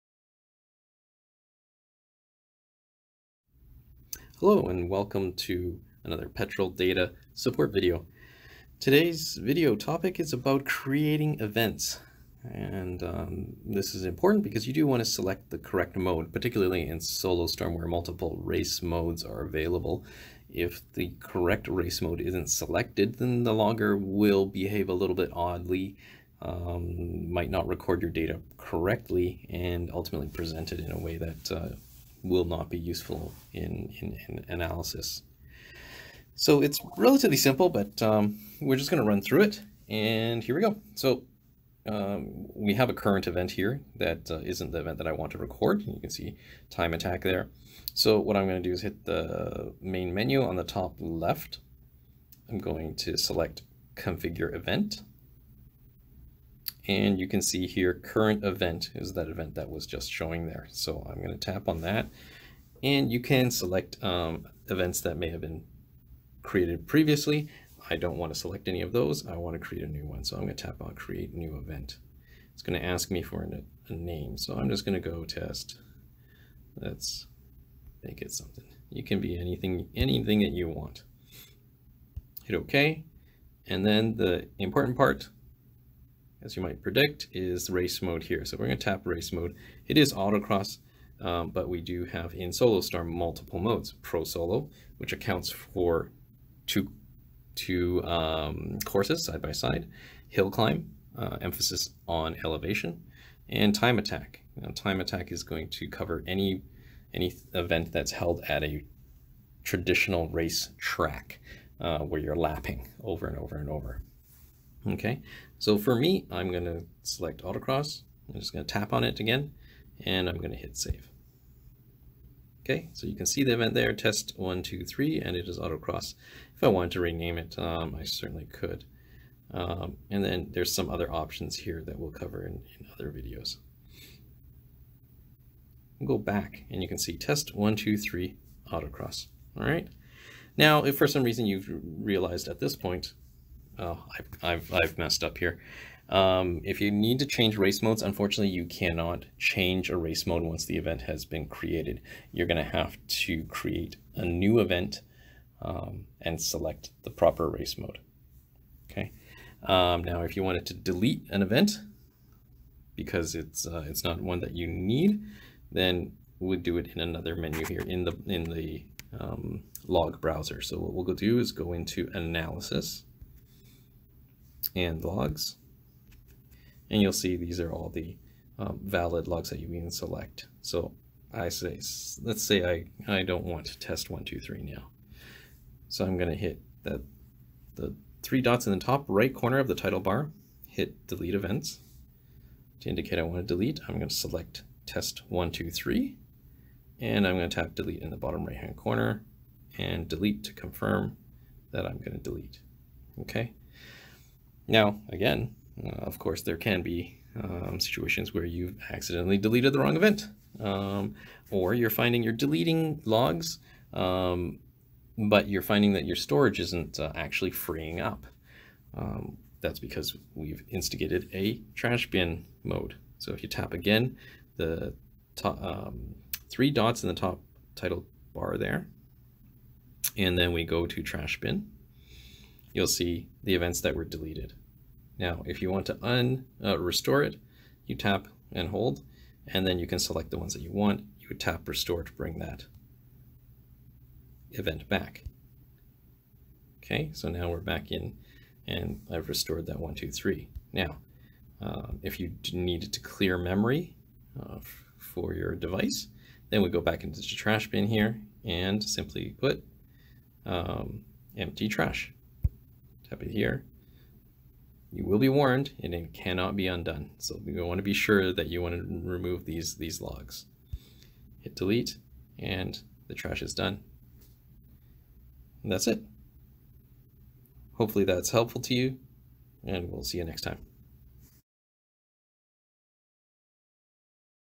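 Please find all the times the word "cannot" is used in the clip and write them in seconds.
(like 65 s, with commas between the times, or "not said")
148 s, 266 s.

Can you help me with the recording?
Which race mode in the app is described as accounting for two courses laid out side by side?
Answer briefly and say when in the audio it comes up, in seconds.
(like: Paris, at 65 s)
Pro Solo, at 94 s.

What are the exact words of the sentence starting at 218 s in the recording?
Um, that's because we've instigated a trash bin mode.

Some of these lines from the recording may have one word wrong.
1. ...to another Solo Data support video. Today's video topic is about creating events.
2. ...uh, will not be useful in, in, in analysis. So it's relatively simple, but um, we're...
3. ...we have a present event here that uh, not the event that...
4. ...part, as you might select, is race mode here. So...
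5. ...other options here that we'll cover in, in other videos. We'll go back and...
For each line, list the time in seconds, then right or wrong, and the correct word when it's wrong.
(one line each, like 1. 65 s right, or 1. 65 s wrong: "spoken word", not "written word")
1. 5 s wrong: "Petrel", not "Solo"
2. 31 s right
3. 42 s wrong: "current", not "present"
4. 84 s wrong: "predict", not "select"
5. 130 s right.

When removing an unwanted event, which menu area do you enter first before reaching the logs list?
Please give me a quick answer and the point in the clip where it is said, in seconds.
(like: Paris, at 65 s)
analysis and logs, at 172 s.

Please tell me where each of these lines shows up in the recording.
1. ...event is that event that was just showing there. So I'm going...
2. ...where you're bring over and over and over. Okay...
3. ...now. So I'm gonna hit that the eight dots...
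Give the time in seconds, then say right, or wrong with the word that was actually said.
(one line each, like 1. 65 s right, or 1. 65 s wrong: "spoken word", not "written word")
1. 58 s right
2. 111 s wrong: "lapping", not "bring"
3. 184 s wrong: "three", not "eight".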